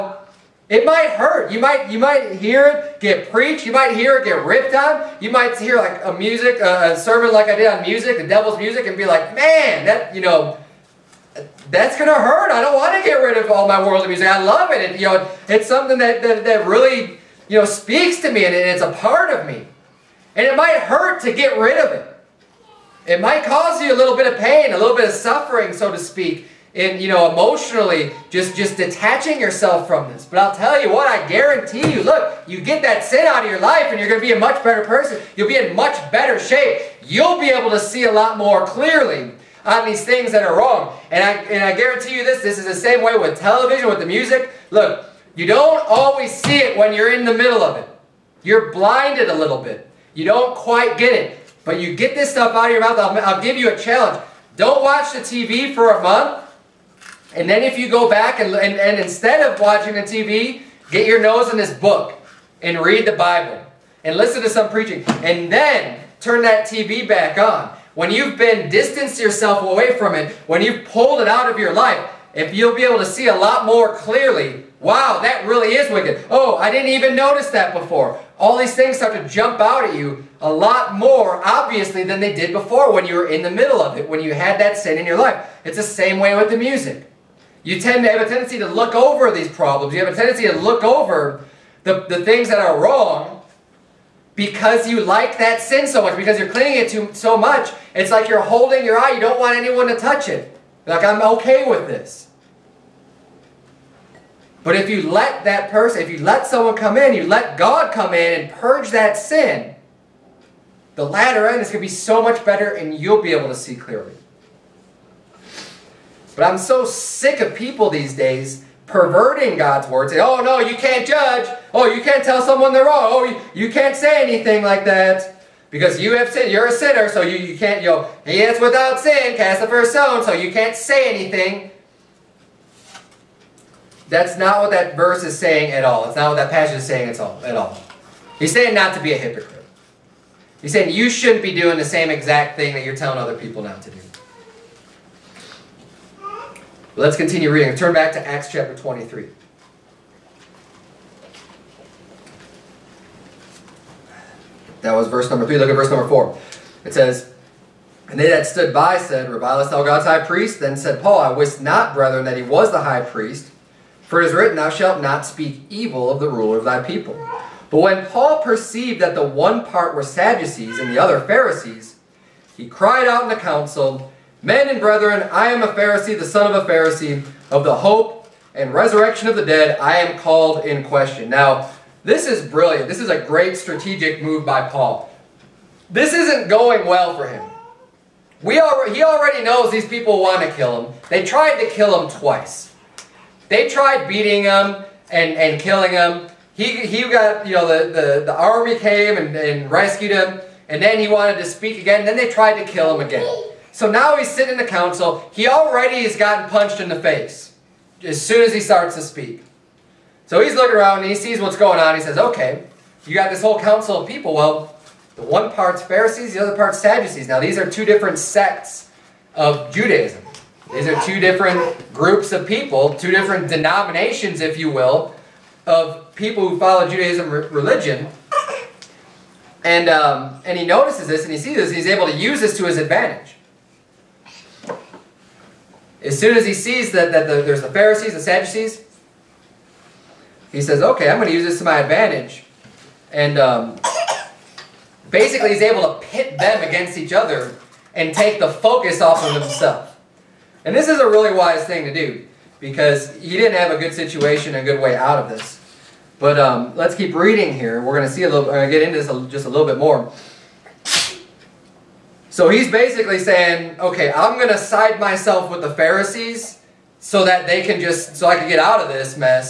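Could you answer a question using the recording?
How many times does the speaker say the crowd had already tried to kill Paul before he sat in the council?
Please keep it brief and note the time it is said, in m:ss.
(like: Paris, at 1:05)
2, at 3:12.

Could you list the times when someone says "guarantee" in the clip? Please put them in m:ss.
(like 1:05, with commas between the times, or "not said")
0:31, 0:41.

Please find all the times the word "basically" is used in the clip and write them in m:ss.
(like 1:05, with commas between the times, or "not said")
4:05, 4:22.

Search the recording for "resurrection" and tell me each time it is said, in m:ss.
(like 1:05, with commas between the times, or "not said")
2:58.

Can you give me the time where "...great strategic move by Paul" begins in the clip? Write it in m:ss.
3:03.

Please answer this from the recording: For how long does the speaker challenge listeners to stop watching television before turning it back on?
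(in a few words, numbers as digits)
A month.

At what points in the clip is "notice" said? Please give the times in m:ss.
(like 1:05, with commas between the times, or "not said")
1:17, 3:50.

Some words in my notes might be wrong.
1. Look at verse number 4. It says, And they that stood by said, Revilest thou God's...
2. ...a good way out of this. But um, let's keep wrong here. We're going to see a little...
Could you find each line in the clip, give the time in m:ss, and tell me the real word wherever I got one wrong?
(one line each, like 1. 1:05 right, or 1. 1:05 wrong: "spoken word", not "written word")
1. 2:35 right
2. 4:14 wrong: "reading", not "wrong".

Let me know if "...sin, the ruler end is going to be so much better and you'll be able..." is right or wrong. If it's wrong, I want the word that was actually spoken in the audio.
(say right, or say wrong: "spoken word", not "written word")
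wrong: "latter", not "ruler".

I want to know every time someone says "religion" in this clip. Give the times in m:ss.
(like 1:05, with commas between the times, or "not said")
3:47.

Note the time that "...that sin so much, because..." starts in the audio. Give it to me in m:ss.
1:35.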